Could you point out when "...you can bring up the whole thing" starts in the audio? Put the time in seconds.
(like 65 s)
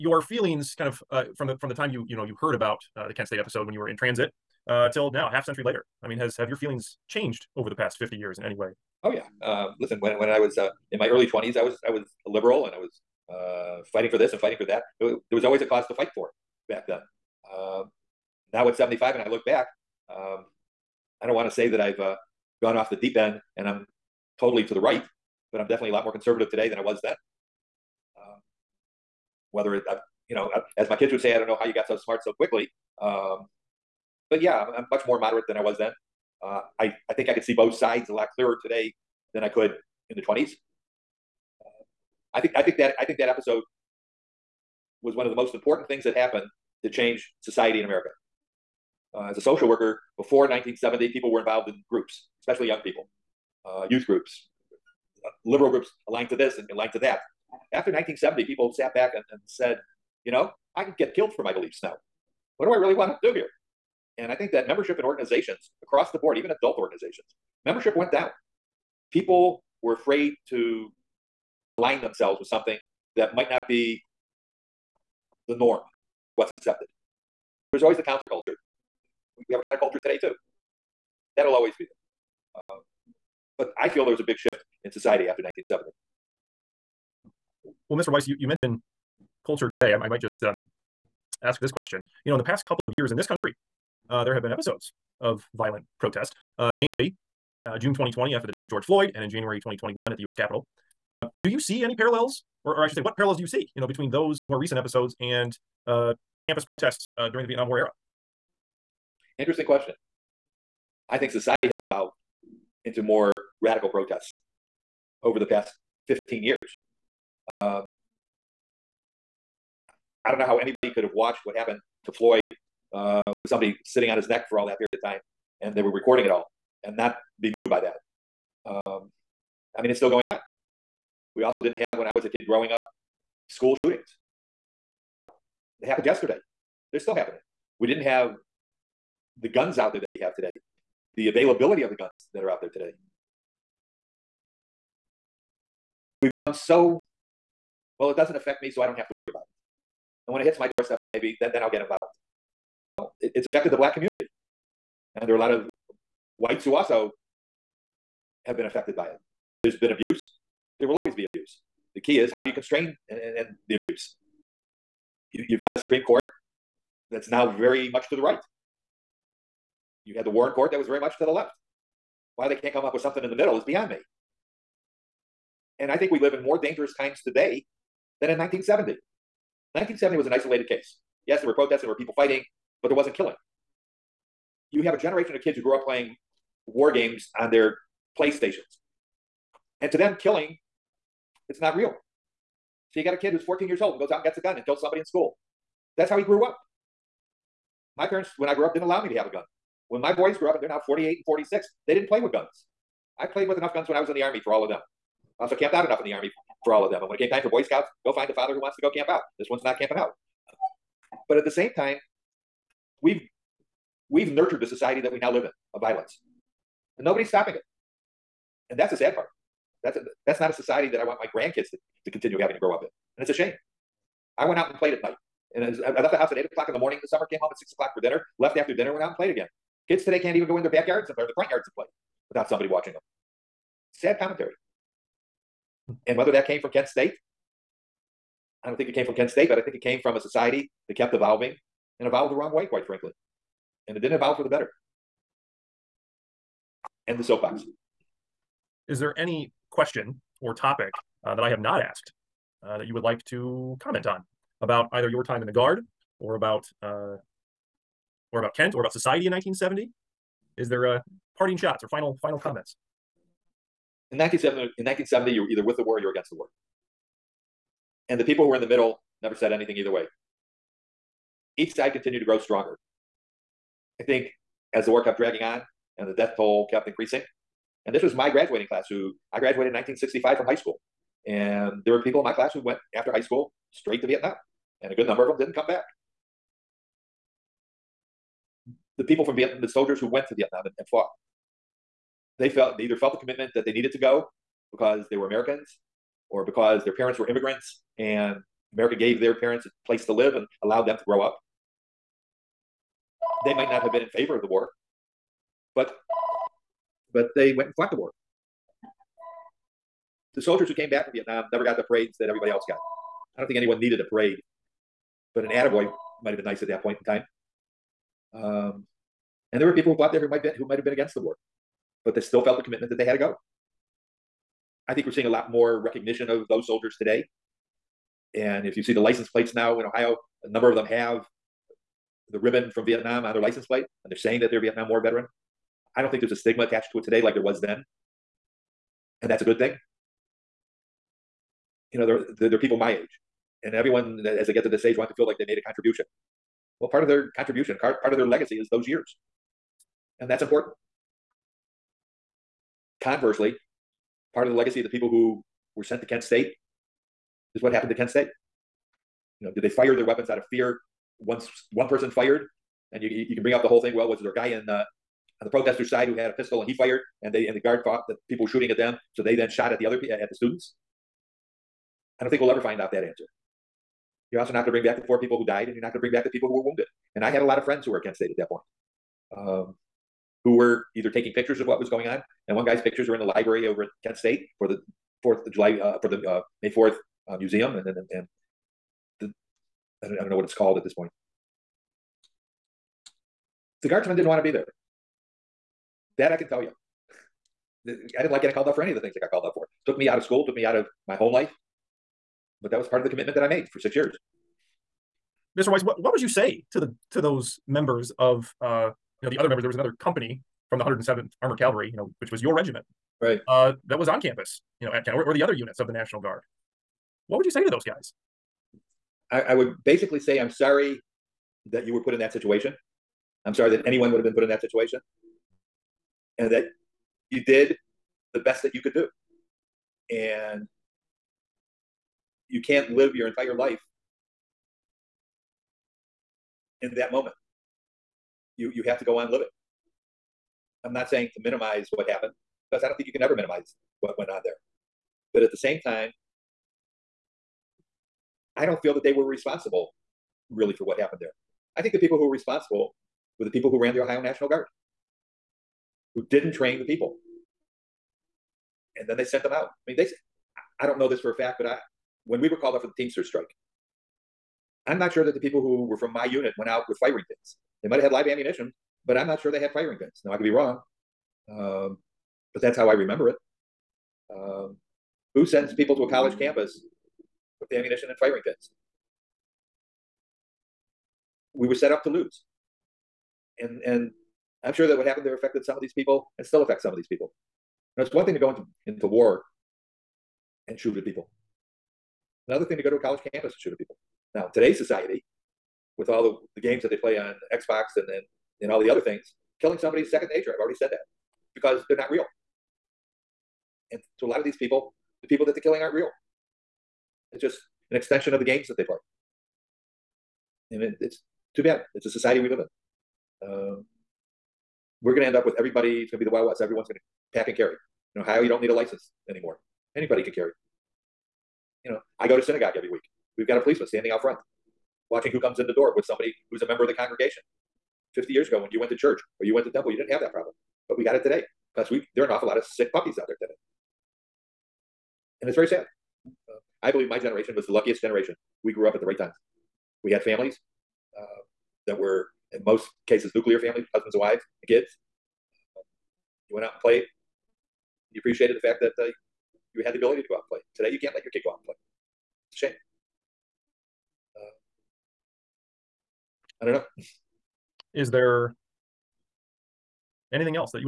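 363 s.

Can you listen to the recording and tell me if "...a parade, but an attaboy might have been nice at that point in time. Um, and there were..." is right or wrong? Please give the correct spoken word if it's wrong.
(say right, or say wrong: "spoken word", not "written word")
right.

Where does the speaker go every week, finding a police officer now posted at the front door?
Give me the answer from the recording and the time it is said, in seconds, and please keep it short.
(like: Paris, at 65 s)
Synagogue, at 522 s.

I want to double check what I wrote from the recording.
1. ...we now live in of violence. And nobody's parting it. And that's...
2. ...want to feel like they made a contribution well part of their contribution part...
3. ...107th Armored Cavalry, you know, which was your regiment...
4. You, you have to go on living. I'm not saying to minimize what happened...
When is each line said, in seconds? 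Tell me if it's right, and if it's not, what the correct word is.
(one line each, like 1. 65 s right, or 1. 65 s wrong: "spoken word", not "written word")
1. 215 s wrong: "stopping", not "parting"
2. 344 s right
3. 410 s right
4. 438 s right.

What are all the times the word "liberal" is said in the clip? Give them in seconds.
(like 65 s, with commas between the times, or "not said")
12 s, 55 s.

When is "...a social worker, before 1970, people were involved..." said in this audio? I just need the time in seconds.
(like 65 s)
49 s.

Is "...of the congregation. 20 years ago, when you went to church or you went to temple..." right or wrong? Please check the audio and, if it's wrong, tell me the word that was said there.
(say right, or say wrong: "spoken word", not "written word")
wrong: "50", not "20".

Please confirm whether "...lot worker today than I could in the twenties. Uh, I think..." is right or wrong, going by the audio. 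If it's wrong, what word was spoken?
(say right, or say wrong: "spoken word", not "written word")
wrong: "clearer", not "worker".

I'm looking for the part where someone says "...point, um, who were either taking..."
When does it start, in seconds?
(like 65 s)
378 s.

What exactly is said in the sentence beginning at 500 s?
I've already said that because they're not real.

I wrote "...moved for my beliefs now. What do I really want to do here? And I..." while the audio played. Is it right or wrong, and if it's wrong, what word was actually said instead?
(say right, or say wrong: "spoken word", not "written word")
wrong: "killed", not "moved".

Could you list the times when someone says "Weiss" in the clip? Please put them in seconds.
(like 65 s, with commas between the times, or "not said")
88 s, 405 s.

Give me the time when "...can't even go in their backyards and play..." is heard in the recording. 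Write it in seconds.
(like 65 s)
230 s.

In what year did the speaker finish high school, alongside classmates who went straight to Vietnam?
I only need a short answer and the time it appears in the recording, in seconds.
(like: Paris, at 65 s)
1965, at 279 s.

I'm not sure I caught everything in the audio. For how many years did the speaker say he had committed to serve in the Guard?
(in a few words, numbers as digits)
6.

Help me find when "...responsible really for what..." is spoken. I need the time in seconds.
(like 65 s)
449 s.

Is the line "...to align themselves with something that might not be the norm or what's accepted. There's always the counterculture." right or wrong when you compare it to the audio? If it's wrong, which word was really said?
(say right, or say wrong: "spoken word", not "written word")
right.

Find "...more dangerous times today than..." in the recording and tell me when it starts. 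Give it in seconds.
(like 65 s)
176 s.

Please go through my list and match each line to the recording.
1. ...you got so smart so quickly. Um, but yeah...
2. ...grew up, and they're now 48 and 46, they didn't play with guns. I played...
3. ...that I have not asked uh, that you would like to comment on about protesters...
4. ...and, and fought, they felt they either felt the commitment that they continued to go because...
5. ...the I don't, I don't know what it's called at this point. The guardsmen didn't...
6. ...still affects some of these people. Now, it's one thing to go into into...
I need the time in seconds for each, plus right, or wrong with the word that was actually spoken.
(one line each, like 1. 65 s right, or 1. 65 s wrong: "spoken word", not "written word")
1. 31 s right
2. 200 s right
3. 251 s wrong: "either", not "protesters"
4. 290 s wrong: "needed", not "continued"
5. 389 s right
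6. 486 s right.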